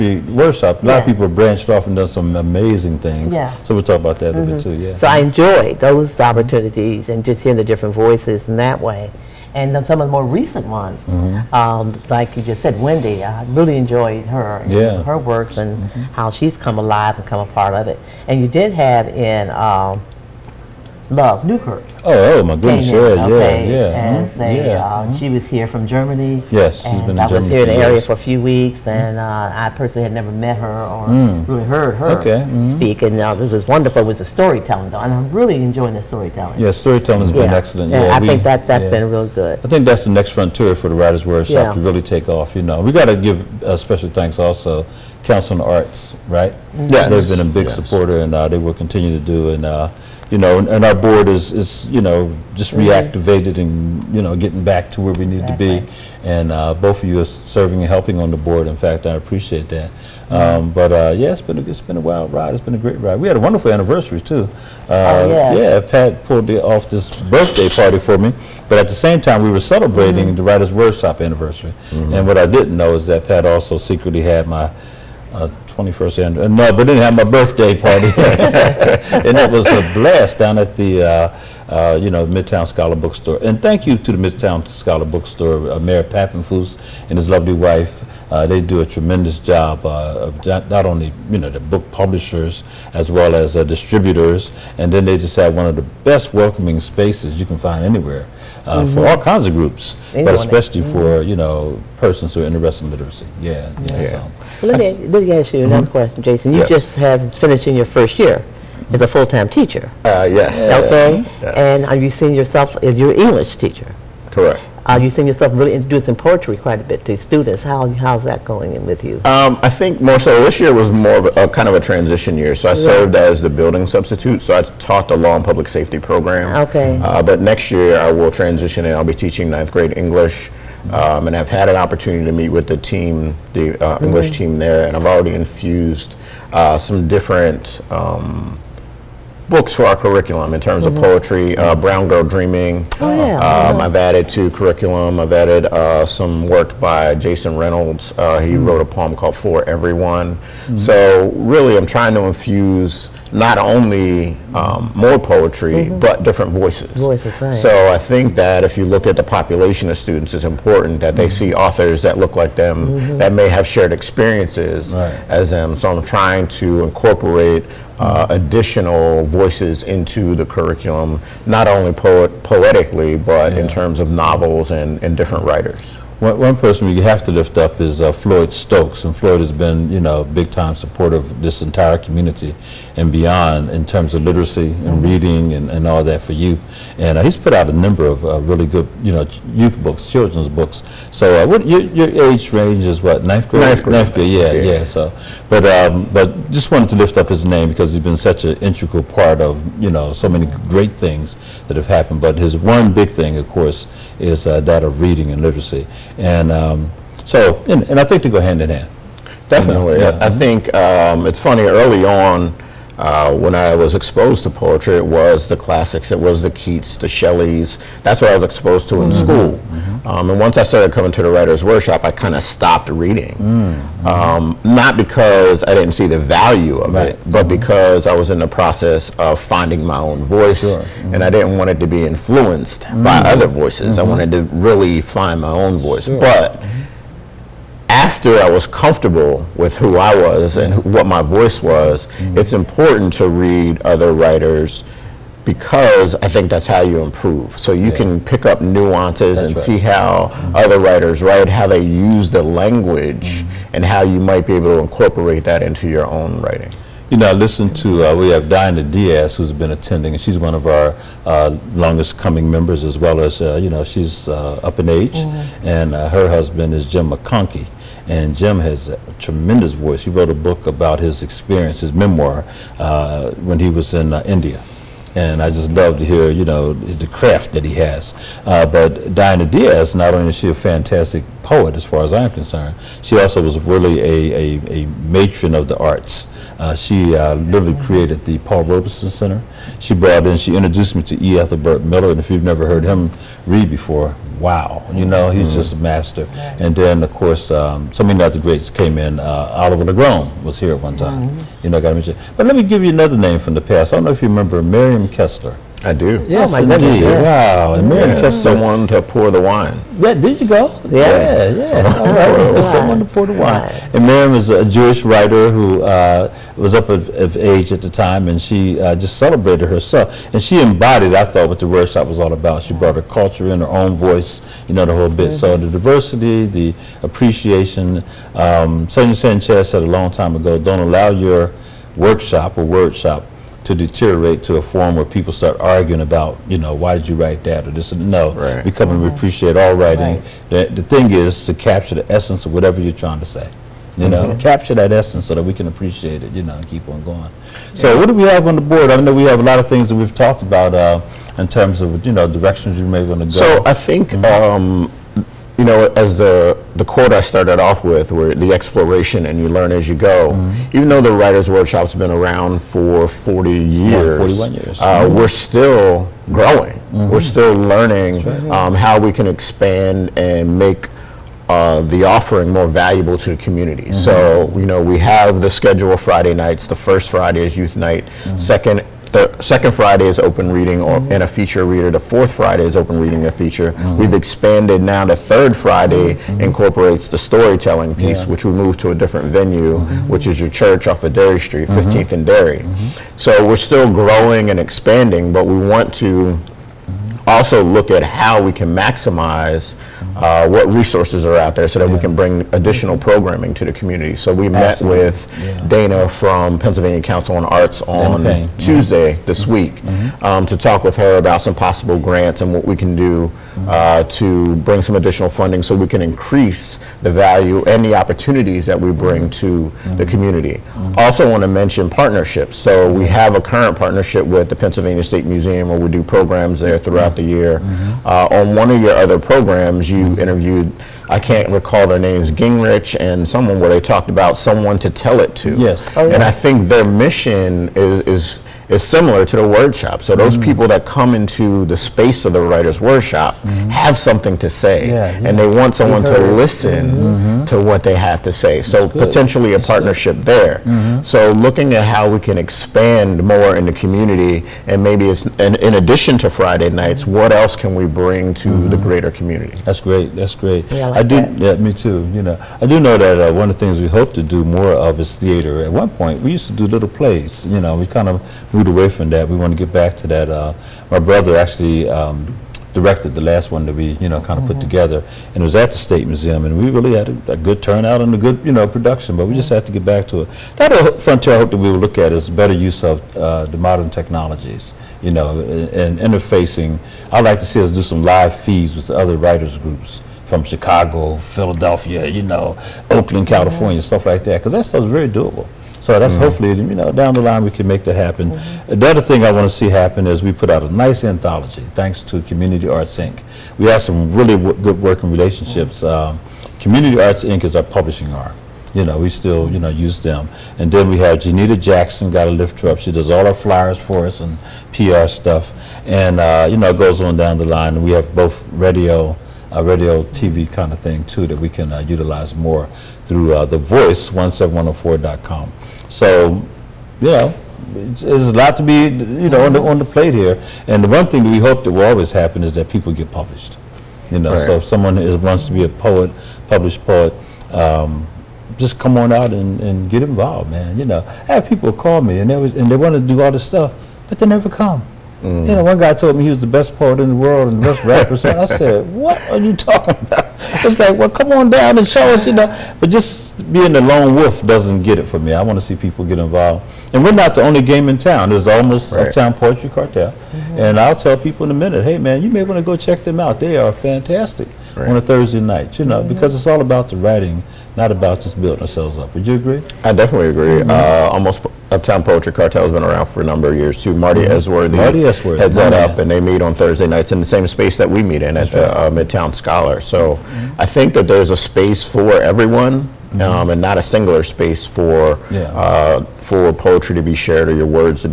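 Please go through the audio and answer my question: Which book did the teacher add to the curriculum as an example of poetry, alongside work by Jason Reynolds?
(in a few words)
Brown Girl Dreaming.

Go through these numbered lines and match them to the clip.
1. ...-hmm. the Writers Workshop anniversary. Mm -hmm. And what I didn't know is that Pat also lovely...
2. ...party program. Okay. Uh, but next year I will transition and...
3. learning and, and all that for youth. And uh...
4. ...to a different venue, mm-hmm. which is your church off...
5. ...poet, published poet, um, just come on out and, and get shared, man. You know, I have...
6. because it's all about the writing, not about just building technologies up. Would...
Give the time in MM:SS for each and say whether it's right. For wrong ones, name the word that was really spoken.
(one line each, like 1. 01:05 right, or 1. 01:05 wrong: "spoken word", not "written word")
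1. 01:10 wrong: "secretly", not "lovely"
2. 02:05 wrong: "safety", not "party"
3. 03:05 wrong: "reading", not "learning"
4. 06:28 right
5. 08:55 wrong: "involved", not "shared"
6. 09:26 wrong: "ourselves", not "technologies".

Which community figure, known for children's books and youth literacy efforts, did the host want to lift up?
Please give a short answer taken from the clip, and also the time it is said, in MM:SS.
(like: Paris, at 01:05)
Floyd Stokes, at 02:58.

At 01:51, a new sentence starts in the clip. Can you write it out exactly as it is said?
And are you seeing yourself as your English teacher?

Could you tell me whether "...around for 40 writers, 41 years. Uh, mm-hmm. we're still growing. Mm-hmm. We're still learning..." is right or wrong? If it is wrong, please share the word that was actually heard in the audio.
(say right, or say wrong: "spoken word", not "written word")
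wrong: "years", not "writers".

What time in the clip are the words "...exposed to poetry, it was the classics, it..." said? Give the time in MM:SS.
03:33.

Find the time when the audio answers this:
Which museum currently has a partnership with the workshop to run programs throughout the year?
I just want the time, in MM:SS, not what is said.
07:04.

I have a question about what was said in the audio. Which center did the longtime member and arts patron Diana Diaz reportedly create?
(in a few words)
Paul Robeson Center.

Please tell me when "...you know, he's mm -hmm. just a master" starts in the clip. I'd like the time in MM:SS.
04:54.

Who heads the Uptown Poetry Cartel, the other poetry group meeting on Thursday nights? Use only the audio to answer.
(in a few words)
Marty Esworthy.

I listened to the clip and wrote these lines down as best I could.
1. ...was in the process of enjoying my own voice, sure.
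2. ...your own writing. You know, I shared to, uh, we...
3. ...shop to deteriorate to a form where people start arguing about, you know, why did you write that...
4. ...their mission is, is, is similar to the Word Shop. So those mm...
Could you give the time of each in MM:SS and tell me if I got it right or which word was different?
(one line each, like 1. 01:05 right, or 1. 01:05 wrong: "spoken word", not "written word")
1. 03:48 wrong: "finding", not "enjoying"
2. 04:15 wrong: "listened", not "shared"
3. 05:32 right
4. 07:16 right.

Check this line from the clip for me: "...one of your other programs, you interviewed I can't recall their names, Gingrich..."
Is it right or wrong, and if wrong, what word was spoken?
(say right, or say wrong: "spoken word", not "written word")
right.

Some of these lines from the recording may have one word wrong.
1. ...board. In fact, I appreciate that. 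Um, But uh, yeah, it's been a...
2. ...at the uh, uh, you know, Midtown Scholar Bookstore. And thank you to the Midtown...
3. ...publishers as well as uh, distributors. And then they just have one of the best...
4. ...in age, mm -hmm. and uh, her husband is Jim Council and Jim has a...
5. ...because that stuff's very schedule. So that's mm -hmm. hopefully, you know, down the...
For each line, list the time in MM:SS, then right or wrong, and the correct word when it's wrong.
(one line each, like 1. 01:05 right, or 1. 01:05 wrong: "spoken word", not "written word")
1. 00:58 right
2. 01:20 right
3. 01:31 right
4. 04:24 wrong: "McConkey", not "Council"
5. 08:14 wrong: "doable", not "schedule".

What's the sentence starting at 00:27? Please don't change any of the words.
I was here in the area for a few weeks, mm-hmm.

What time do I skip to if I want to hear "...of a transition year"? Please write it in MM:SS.
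02:01.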